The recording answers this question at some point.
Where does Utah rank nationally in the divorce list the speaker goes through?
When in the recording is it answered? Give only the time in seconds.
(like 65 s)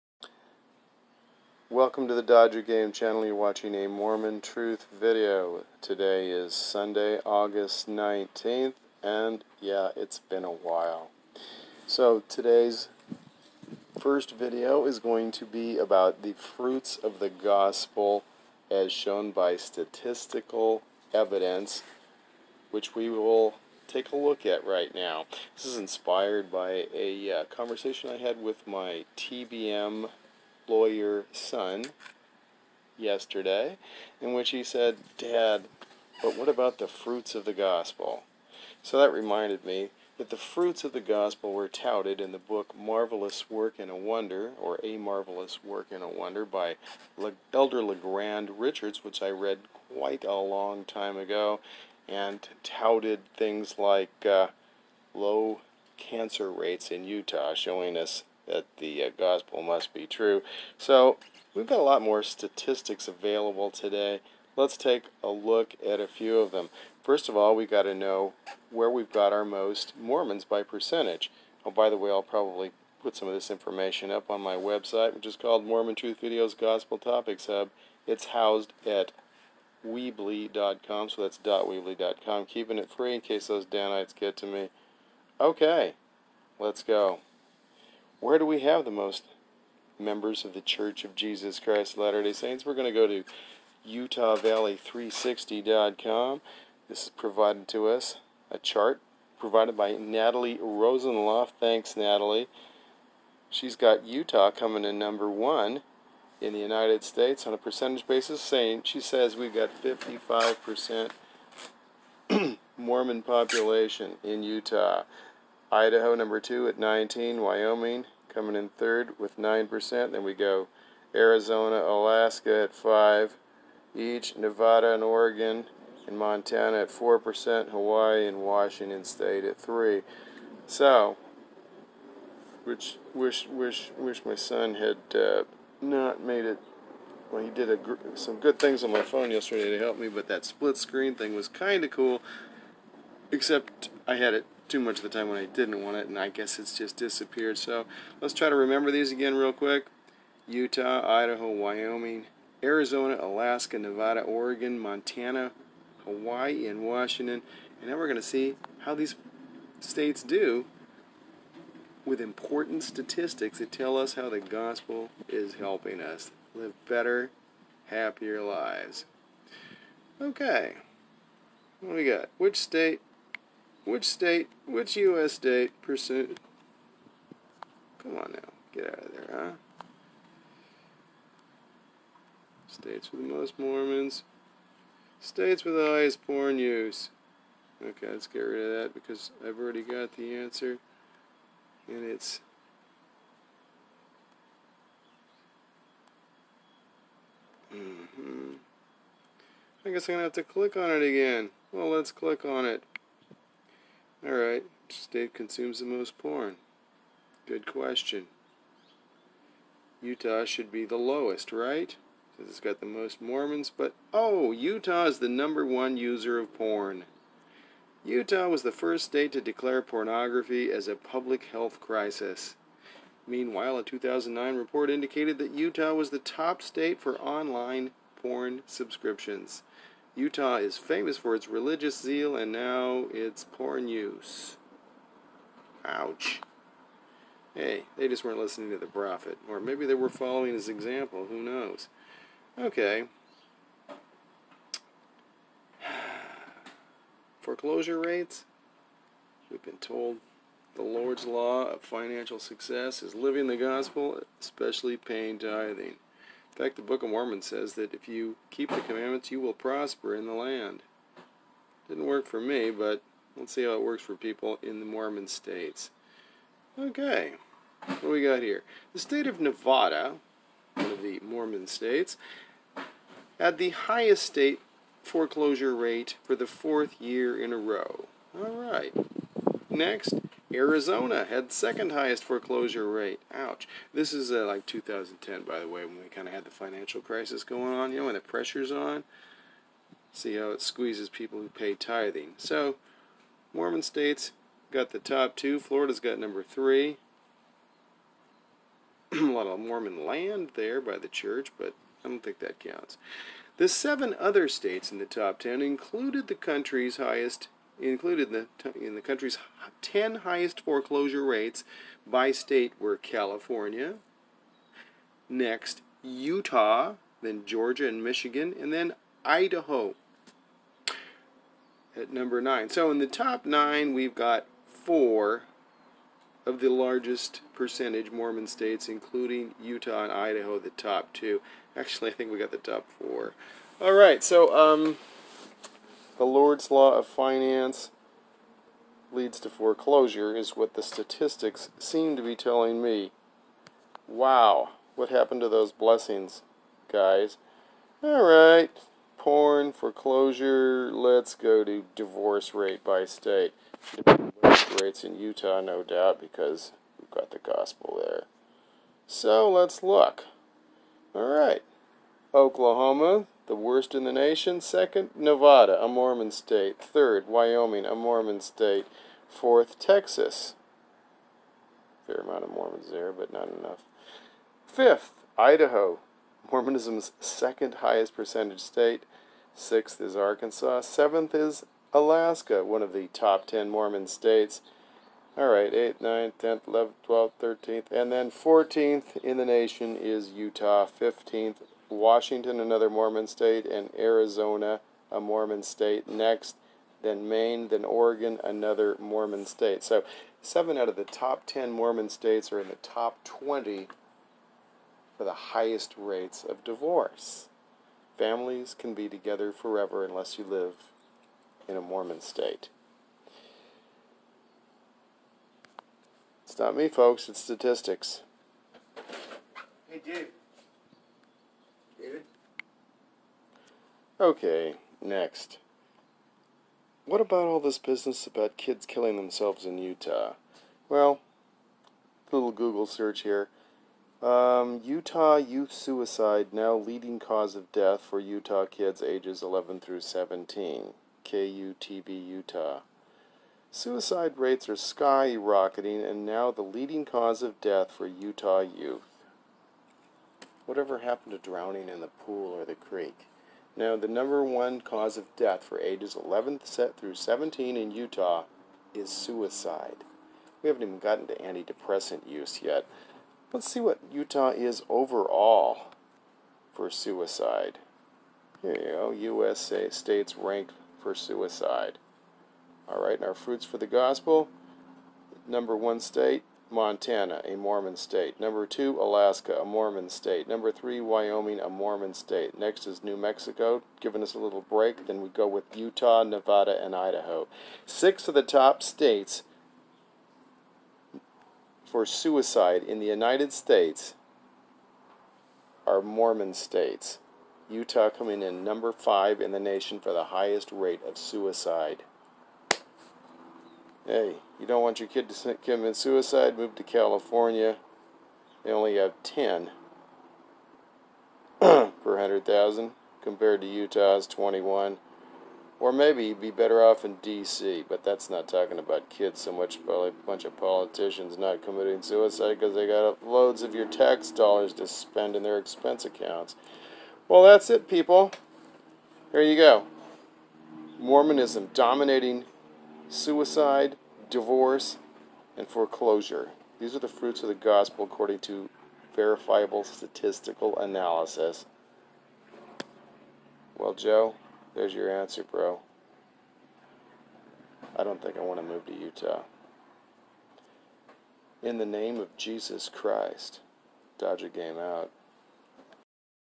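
388 s.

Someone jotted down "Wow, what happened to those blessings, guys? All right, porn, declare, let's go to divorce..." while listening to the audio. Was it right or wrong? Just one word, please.
wrong.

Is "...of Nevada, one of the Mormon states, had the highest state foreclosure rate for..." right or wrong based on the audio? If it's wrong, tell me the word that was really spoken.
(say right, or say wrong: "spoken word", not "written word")
right.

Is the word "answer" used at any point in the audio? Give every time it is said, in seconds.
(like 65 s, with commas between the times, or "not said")
190 s, 545 s.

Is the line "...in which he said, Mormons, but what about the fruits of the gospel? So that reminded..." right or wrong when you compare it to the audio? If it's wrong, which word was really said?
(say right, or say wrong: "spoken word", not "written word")
wrong: "Dad", not "Mormons".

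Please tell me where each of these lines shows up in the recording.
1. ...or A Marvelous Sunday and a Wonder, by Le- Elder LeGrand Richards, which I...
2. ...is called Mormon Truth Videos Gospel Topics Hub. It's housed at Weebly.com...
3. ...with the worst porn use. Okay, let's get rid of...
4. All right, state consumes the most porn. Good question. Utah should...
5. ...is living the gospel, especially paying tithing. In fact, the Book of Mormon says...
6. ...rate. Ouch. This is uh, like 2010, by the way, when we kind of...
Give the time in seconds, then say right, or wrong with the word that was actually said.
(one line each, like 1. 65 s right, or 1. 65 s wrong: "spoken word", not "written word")
1. 44 s wrong: "Work", not "Sunday"
2. 75 s right
3. 185 s wrong: "highest", not "worst"
4. 204 s right
5. 253 s right
6. 282 s right.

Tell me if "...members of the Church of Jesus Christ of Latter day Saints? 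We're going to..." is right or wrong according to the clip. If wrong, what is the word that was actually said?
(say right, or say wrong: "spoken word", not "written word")
right.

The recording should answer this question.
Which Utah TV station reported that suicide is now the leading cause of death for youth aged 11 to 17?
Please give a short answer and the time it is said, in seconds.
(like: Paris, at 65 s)
KUTV, at 441 s.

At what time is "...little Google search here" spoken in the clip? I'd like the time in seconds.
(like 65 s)
432 s.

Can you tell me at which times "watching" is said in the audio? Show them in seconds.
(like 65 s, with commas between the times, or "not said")
3 s.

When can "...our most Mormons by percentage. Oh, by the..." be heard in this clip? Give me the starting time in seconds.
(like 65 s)
69 s.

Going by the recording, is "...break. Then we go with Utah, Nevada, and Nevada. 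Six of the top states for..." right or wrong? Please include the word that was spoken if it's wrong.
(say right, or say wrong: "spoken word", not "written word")
wrong: "Idaho", not "Nevada".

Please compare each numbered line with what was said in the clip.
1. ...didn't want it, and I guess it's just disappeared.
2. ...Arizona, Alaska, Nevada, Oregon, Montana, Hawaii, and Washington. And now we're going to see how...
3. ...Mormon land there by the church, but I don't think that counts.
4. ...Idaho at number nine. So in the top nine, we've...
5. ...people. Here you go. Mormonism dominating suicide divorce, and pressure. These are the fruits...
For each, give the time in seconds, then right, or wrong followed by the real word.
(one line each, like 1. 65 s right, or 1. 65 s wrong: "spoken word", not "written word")
1. 145 s right
2. 152 s right
3. 299 s right
4. 319 s right
5. 527 s wrong: "foreclosure", not "pressure".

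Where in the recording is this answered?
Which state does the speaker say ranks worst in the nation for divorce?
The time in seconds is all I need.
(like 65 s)
362 s.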